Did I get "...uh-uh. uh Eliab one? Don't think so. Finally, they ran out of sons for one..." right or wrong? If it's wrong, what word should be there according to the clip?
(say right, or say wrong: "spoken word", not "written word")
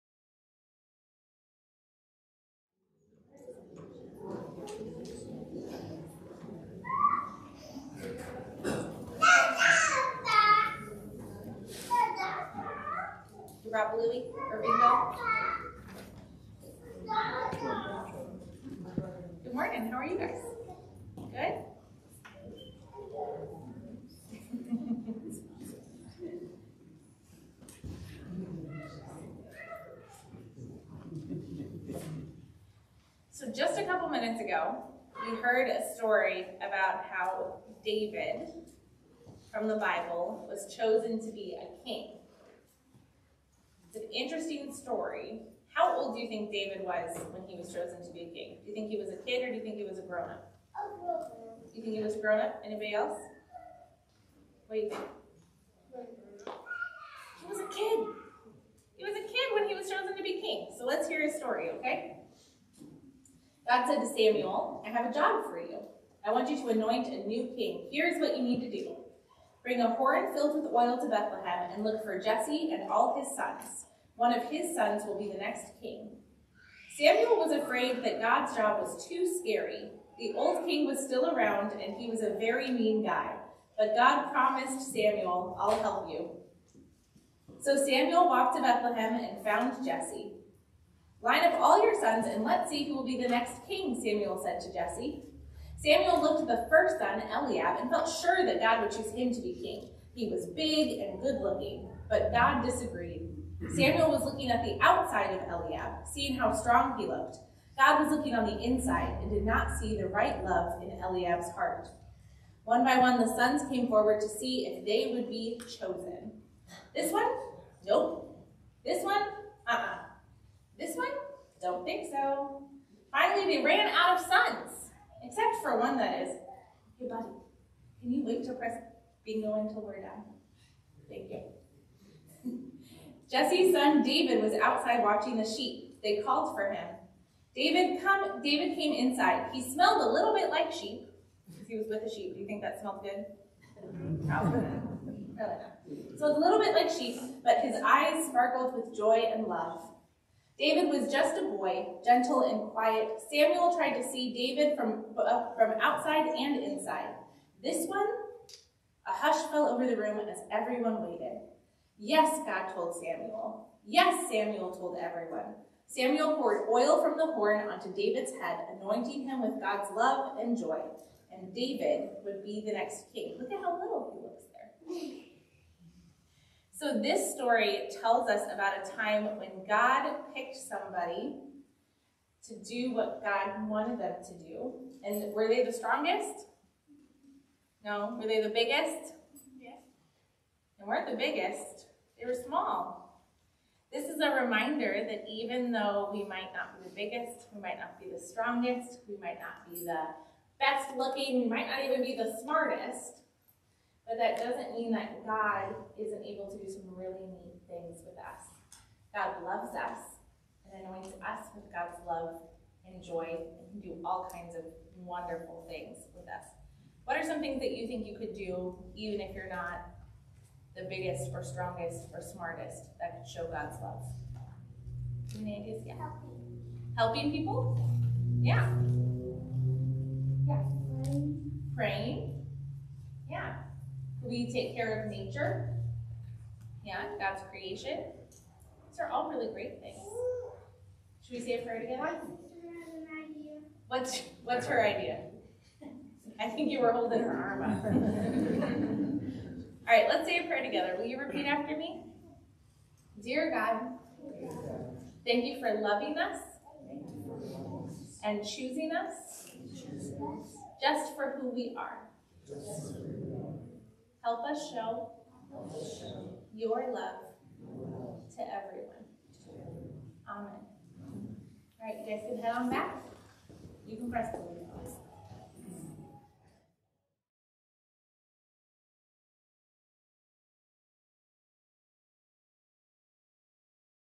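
wrong: "This", not "Eliab".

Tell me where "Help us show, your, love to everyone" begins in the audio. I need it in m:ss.
4:24.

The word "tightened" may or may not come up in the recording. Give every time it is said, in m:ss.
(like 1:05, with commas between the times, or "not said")
not said.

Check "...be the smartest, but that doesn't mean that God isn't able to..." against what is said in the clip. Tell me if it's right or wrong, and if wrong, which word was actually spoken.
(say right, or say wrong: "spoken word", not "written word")
right.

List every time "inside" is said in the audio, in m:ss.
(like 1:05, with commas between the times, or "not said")
1:48, 2:18, 2:36.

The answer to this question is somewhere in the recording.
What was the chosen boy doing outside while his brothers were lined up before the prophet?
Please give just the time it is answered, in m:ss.
2:15.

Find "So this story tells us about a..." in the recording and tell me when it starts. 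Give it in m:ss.
2:56.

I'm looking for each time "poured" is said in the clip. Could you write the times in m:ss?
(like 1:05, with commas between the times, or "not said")
2:46.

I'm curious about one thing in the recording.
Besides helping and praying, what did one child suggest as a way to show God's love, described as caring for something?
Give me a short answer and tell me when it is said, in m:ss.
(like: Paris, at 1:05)
Take care of nature, at 3:54.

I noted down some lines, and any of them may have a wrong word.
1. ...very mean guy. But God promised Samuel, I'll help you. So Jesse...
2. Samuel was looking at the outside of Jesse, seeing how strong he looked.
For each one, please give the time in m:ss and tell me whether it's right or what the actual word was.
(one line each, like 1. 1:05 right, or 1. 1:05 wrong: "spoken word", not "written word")
1. 1:22 wrong: "Samuel", not "Jesse"
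2. 1:43 wrong: "Eliab", not "Jesse".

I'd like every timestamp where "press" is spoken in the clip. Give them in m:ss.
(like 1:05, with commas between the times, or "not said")
2:08, 4:34.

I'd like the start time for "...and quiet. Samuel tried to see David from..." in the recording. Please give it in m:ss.
2:32.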